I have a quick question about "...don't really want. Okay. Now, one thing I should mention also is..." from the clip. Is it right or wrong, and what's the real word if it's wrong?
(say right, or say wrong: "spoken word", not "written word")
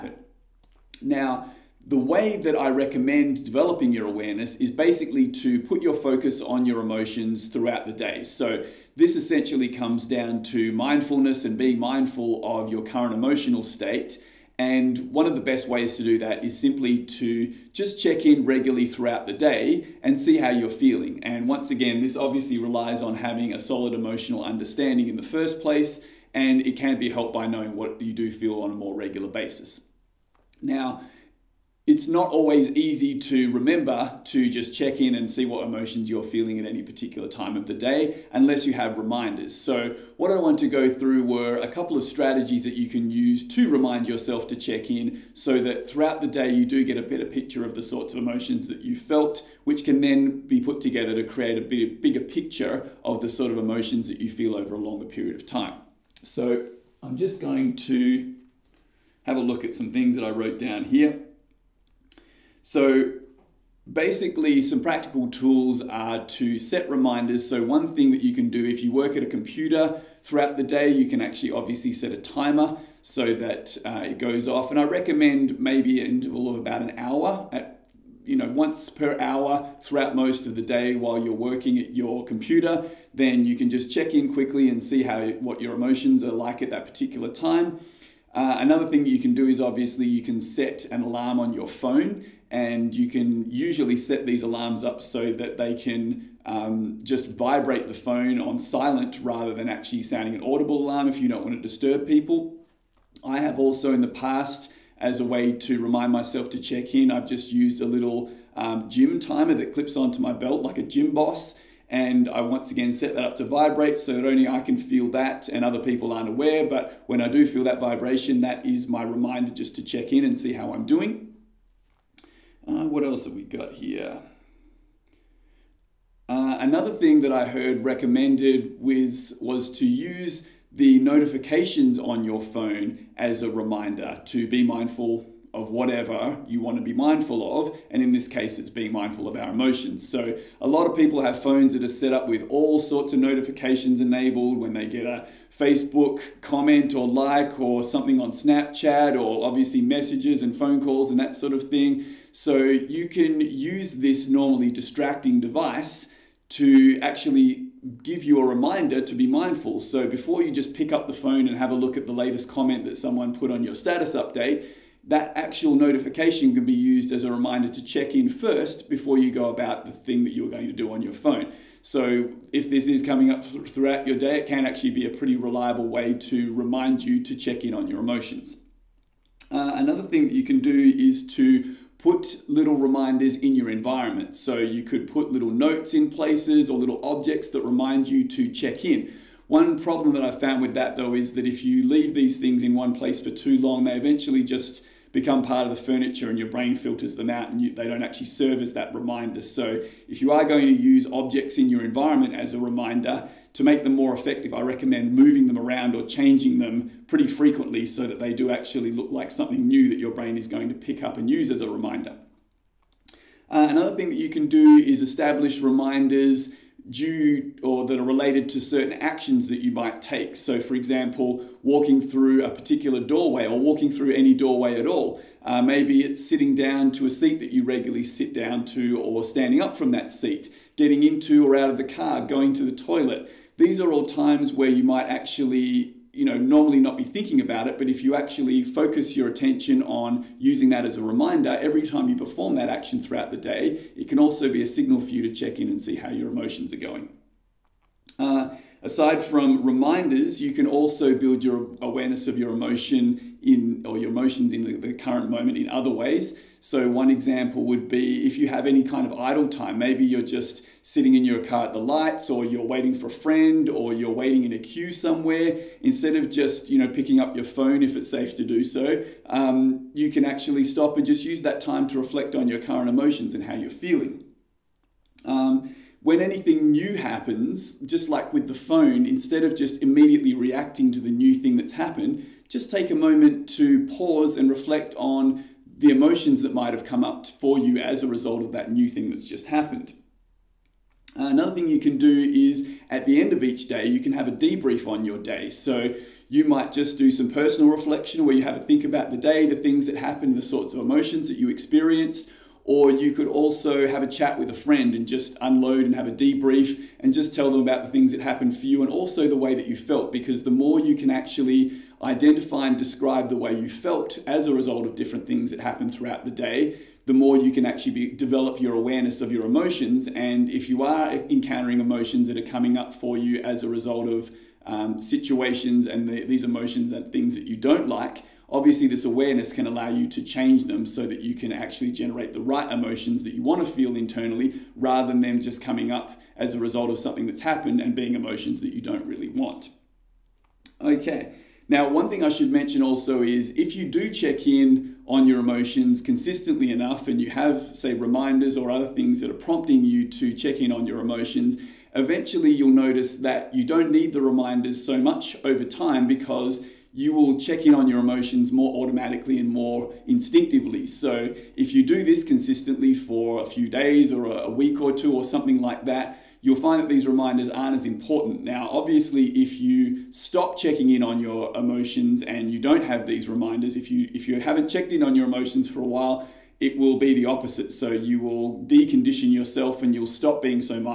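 right.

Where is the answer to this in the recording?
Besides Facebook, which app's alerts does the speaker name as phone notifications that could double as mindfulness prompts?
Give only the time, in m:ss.
2:28.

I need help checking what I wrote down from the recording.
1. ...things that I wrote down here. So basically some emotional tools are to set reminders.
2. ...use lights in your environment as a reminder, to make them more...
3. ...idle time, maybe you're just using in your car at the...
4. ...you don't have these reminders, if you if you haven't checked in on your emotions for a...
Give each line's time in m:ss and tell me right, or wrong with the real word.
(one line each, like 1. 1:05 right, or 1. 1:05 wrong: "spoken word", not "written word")
1. 0:59 wrong: "practical", not "emotional"
2. 3:20 wrong: "objects", not "lights"
3. 4:19 wrong: "sitting", not "using"
4. 6:12 right.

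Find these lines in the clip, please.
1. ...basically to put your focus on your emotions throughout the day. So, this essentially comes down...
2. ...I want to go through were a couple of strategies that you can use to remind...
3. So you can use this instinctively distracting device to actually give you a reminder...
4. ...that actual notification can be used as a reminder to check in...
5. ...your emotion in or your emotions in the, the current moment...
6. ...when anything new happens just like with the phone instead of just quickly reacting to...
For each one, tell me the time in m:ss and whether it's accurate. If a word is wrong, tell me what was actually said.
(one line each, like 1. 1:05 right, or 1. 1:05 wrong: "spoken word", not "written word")
1. 0:04 right
2. 0:40 right
3. 2:32 wrong: "normally", not "instinctively"
4. 2:45 right
5. 4:12 right
6. 4:36 wrong: "immediately", not "quickly".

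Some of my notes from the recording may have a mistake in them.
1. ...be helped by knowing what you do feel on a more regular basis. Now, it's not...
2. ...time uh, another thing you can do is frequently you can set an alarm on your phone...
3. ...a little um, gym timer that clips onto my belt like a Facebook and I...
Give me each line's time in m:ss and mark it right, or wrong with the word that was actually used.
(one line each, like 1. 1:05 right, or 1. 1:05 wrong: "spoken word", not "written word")
1. 0:26 right
2. 1:27 wrong: "obviously", not "frequently"
3. 1:47 wrong: "Gymboss", not "Facebook".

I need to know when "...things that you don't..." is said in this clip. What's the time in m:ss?
5:27.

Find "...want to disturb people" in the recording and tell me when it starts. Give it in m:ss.
1:41.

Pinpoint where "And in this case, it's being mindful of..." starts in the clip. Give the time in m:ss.
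2:17.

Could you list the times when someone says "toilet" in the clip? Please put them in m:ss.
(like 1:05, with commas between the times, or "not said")
3:52.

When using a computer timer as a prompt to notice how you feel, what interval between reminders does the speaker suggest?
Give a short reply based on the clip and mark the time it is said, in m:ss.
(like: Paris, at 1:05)
1 hour, at 1:16.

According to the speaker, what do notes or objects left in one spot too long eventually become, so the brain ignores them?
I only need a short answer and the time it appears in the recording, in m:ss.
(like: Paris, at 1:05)
part of the furniture, at 3:15.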